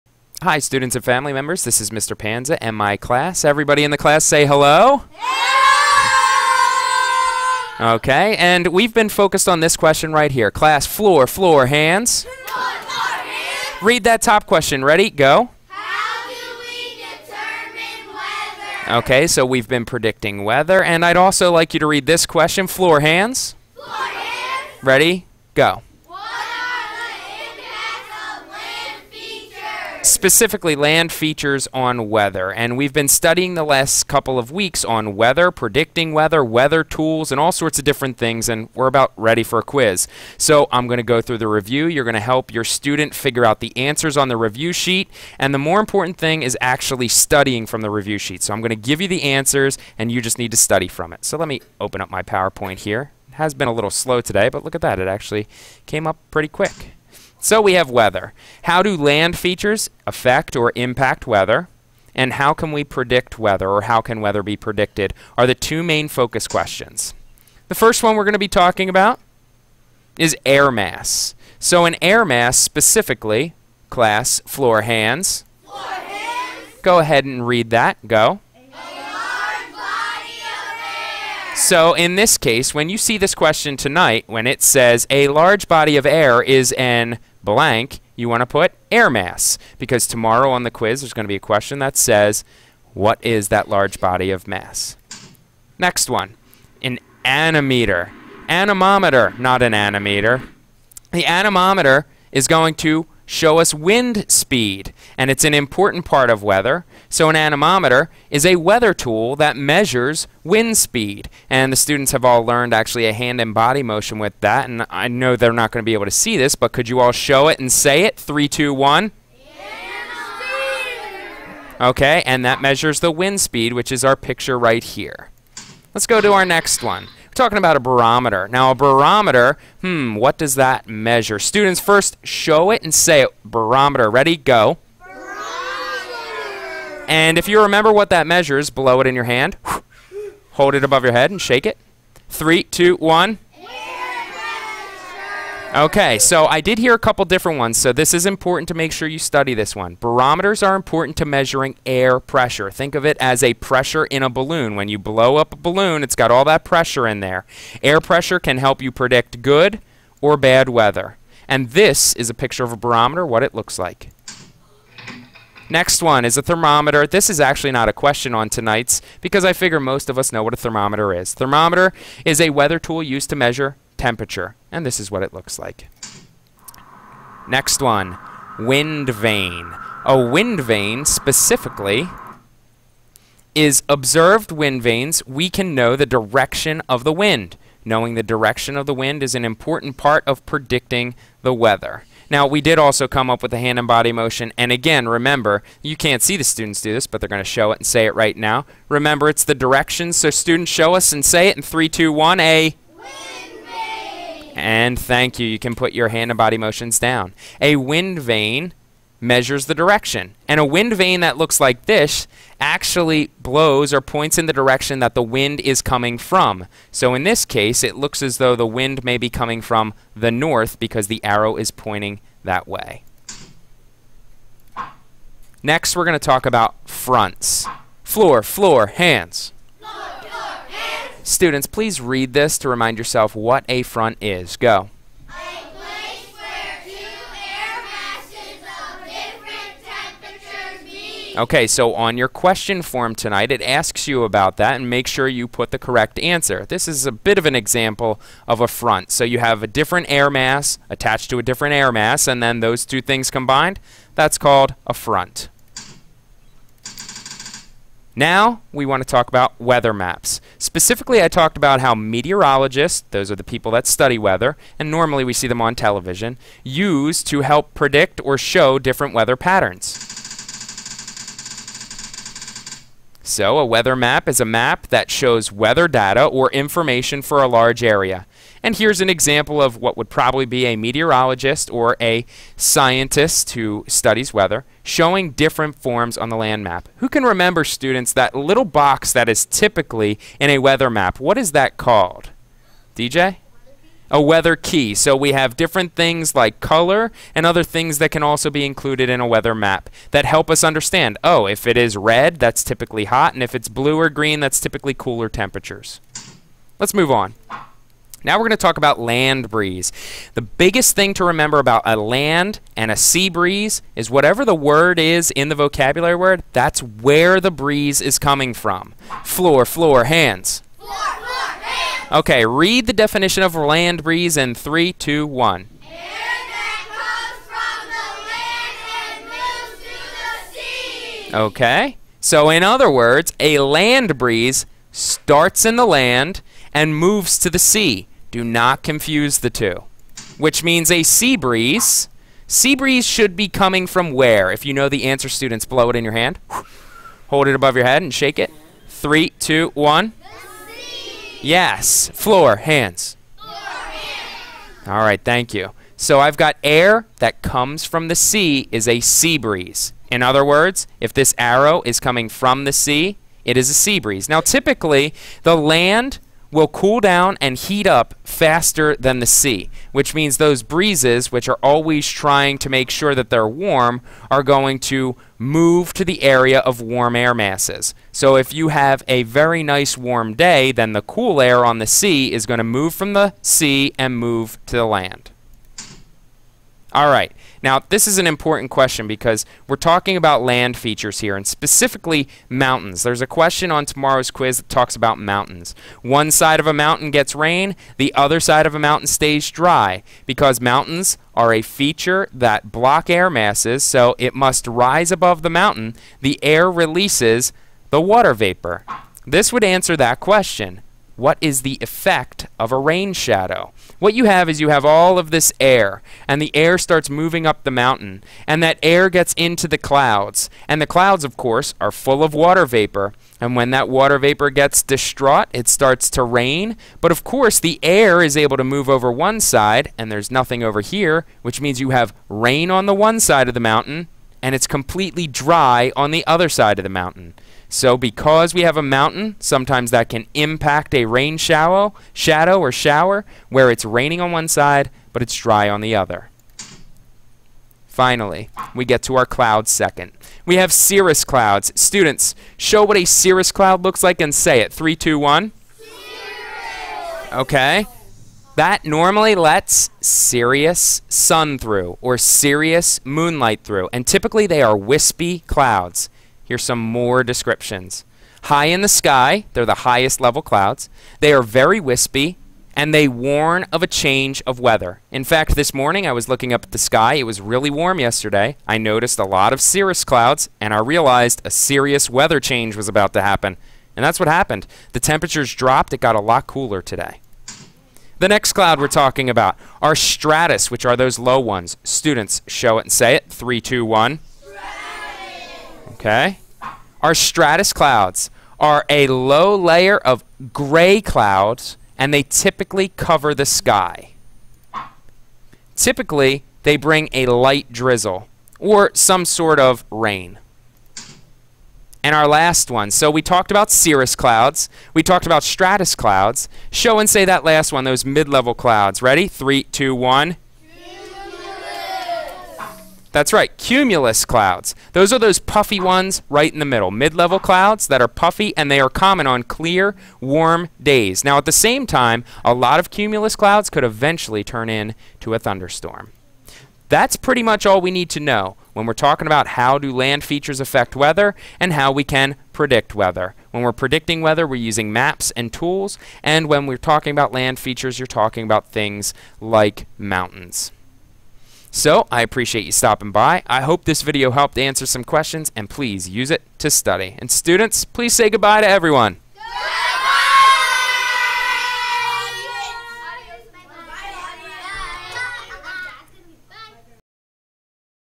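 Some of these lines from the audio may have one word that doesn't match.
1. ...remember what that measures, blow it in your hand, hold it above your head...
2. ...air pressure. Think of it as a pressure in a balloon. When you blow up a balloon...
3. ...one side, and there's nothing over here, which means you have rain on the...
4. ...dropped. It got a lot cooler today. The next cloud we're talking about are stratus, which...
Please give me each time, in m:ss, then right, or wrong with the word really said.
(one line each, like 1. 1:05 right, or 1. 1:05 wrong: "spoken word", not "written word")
1. 2:17 right
2. 2:31 right
3. 7:09 right
4. 8:05 right.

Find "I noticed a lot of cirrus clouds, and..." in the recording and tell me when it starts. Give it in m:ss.
7:58.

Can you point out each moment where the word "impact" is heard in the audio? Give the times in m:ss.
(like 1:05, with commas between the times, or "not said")
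1:00, 7:20.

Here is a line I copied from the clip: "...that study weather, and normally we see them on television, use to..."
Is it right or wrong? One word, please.
right.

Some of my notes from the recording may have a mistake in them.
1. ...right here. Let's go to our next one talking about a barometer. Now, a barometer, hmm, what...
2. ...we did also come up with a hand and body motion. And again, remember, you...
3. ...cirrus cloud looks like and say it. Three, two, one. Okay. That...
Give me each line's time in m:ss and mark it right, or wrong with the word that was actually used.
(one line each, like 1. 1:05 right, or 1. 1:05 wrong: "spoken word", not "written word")
1. 2:04 right
2. 3:12 right
3. 7:33 right.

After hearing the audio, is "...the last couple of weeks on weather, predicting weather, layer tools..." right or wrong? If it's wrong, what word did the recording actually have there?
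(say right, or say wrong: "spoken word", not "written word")
wrong: "weather", not "layer".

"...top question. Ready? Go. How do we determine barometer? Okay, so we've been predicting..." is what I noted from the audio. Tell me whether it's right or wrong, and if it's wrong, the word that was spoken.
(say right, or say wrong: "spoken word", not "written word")
wrong: "weather", not "barometer".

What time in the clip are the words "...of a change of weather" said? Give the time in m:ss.
7:53.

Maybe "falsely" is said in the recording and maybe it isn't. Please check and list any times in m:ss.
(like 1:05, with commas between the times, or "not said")
not said.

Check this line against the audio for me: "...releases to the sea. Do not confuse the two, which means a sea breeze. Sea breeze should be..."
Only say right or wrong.
wrong.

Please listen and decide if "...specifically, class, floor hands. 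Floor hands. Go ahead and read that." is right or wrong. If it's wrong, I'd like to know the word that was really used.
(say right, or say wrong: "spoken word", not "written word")
right.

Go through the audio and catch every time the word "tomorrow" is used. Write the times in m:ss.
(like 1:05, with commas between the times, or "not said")
1:30, 6:33.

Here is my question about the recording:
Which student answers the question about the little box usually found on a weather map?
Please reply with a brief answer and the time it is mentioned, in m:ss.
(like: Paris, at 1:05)
DJ, at 4:52.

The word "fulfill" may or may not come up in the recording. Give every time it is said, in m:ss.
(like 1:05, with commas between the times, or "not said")
not said.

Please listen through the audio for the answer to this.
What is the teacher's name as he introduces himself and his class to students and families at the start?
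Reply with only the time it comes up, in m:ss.
0:01.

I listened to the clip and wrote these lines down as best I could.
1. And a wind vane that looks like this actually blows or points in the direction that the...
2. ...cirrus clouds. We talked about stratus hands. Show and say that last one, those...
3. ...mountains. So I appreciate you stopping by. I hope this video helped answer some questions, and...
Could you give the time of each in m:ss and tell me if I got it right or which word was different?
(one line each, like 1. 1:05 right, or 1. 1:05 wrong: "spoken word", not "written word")
1. 3:30 right
2. 8:33 wrong: "clouds", not "hands"
3. 9:09 right.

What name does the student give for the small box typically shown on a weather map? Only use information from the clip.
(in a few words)
weather key.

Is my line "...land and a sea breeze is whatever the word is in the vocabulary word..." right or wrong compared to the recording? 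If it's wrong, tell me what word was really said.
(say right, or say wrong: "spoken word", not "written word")
right.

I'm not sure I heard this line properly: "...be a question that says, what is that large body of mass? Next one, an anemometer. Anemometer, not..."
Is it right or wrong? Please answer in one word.
right.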